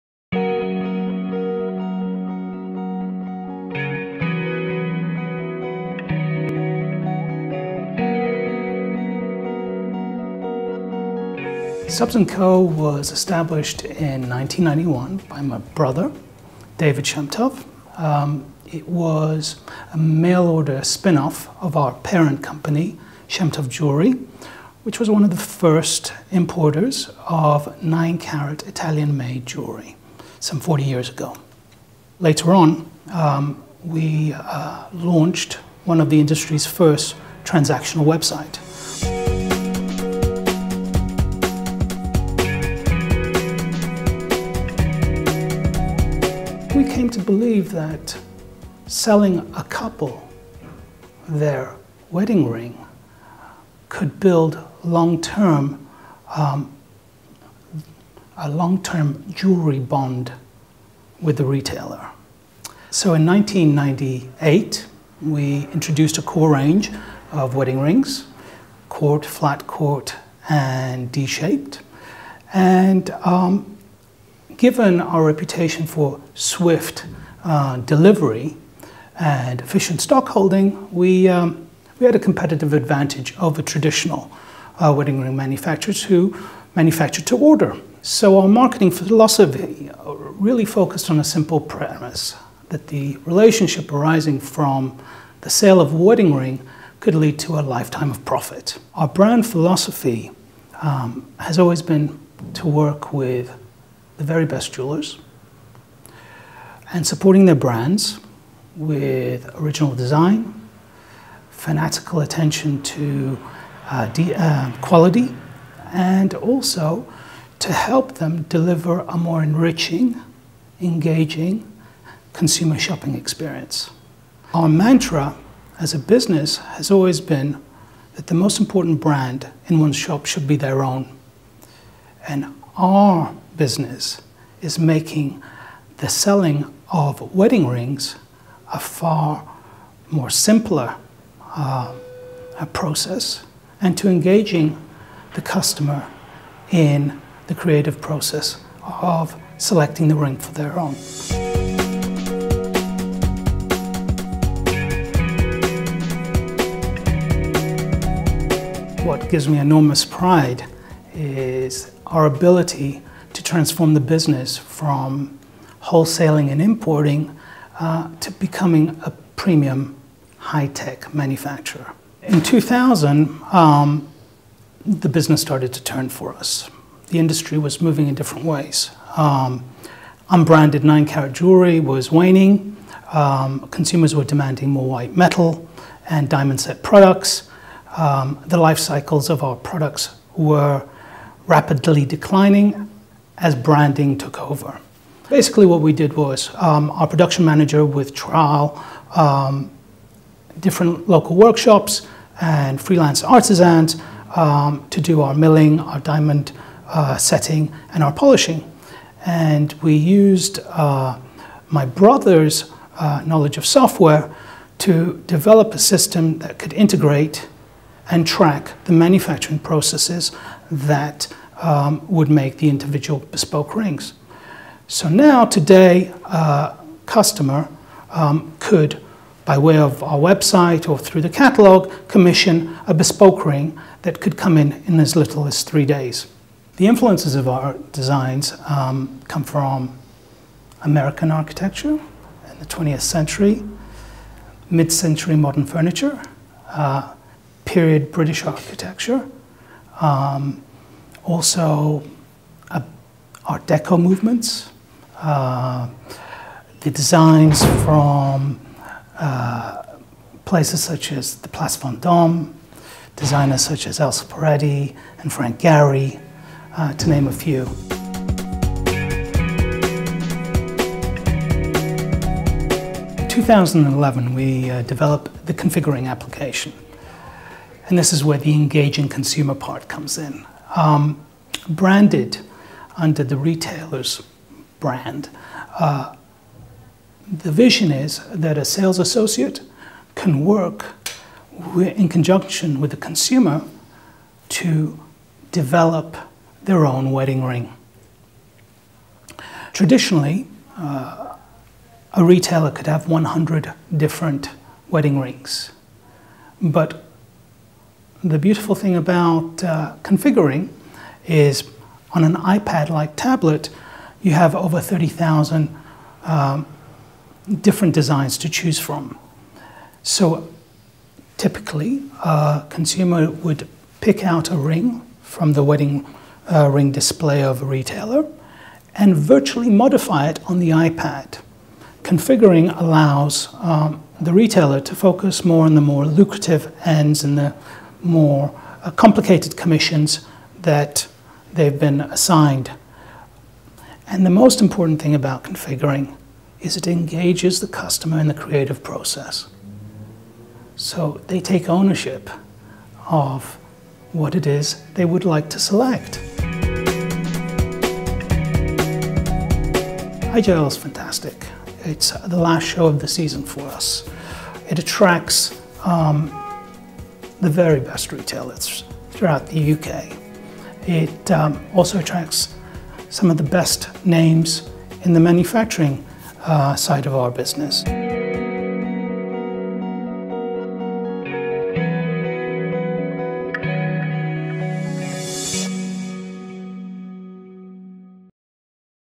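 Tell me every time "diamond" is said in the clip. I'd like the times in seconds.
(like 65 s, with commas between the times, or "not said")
186 s, 205 s.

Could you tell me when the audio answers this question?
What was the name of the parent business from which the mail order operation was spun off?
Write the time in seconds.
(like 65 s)
23 s.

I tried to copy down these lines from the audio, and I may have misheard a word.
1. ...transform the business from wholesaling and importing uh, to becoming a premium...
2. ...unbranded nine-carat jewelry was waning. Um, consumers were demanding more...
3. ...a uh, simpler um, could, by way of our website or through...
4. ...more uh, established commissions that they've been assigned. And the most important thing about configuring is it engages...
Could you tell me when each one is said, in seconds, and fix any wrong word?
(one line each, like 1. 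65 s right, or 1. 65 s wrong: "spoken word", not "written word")
1. 163 s right
2. 180 s right
3. 226 s wrong: "customer", not "simpler"
4. 338 s wrong: "complicated", not "established".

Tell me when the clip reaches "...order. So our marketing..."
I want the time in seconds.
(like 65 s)
87 s.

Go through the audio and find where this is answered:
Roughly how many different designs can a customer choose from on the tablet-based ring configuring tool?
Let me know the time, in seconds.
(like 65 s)
314 s.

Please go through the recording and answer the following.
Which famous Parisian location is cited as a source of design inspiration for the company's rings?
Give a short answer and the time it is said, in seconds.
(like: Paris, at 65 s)
Place Vendôme, at 261 s.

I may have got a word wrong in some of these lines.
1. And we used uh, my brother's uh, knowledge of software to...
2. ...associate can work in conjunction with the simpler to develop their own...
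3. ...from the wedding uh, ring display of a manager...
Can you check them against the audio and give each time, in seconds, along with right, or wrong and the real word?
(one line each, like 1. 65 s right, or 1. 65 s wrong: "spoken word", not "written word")
1. 209 s right
2. 288 s wrong: "consumer", not "simpler"
3. 325 s wrong: "retailer", not "manager".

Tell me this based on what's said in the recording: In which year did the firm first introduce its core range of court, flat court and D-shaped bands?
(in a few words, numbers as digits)
1998.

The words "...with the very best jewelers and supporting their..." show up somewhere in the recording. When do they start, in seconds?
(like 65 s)
103 s.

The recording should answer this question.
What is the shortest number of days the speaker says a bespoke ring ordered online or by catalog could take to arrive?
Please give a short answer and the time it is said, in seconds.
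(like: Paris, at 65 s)
3 days, at 235 s.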